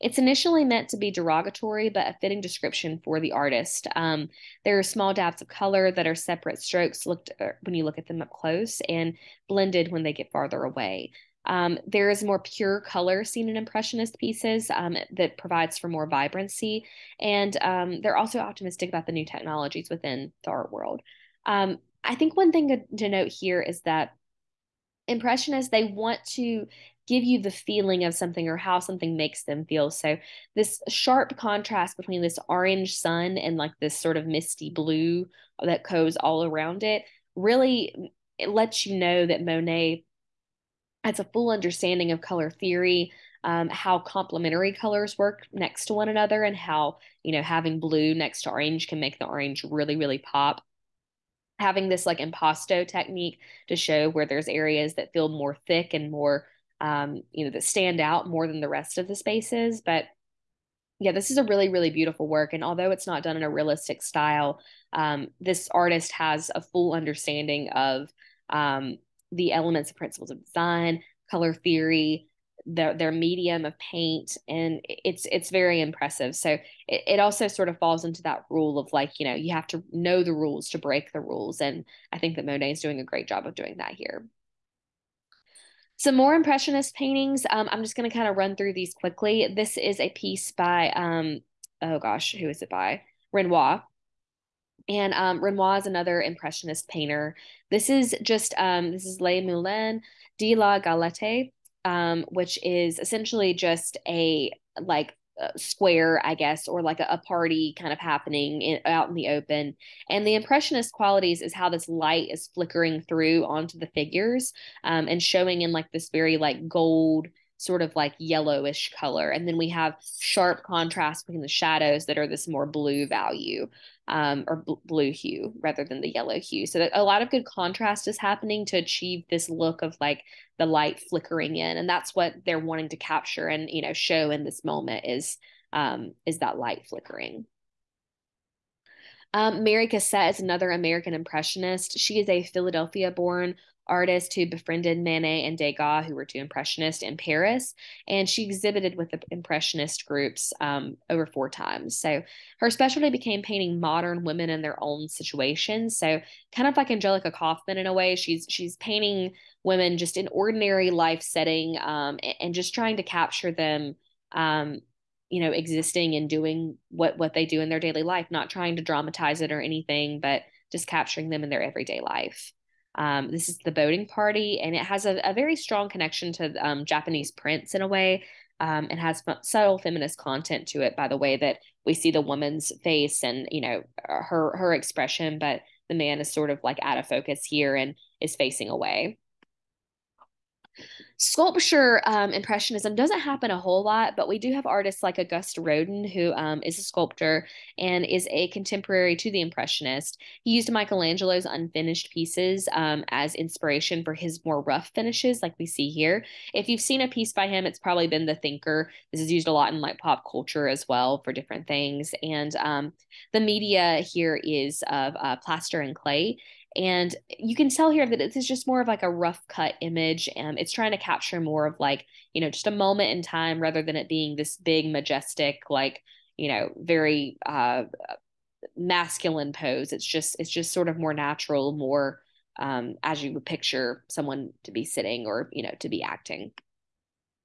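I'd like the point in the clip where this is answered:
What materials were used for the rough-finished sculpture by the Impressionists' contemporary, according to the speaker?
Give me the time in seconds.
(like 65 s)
215 s.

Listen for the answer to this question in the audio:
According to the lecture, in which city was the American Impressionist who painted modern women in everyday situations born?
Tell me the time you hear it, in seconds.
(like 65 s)
142 s.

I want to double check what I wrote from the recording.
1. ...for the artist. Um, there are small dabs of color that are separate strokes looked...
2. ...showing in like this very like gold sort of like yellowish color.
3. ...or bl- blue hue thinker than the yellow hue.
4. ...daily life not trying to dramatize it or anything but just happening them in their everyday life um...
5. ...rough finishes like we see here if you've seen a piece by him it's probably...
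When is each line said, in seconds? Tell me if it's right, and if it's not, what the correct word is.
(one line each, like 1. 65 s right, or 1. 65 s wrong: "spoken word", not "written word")
1. 3 s right
2. 115 s right
3. 124 s wrong: "rather", not "thinker"
4. 167 s wrong: "capturing", not "happening"
5. 204 s right.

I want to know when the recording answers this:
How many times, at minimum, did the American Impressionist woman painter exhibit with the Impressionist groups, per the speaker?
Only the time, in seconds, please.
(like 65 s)
151 s.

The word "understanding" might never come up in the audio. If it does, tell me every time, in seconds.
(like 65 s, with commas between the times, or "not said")
41 s, 66 s.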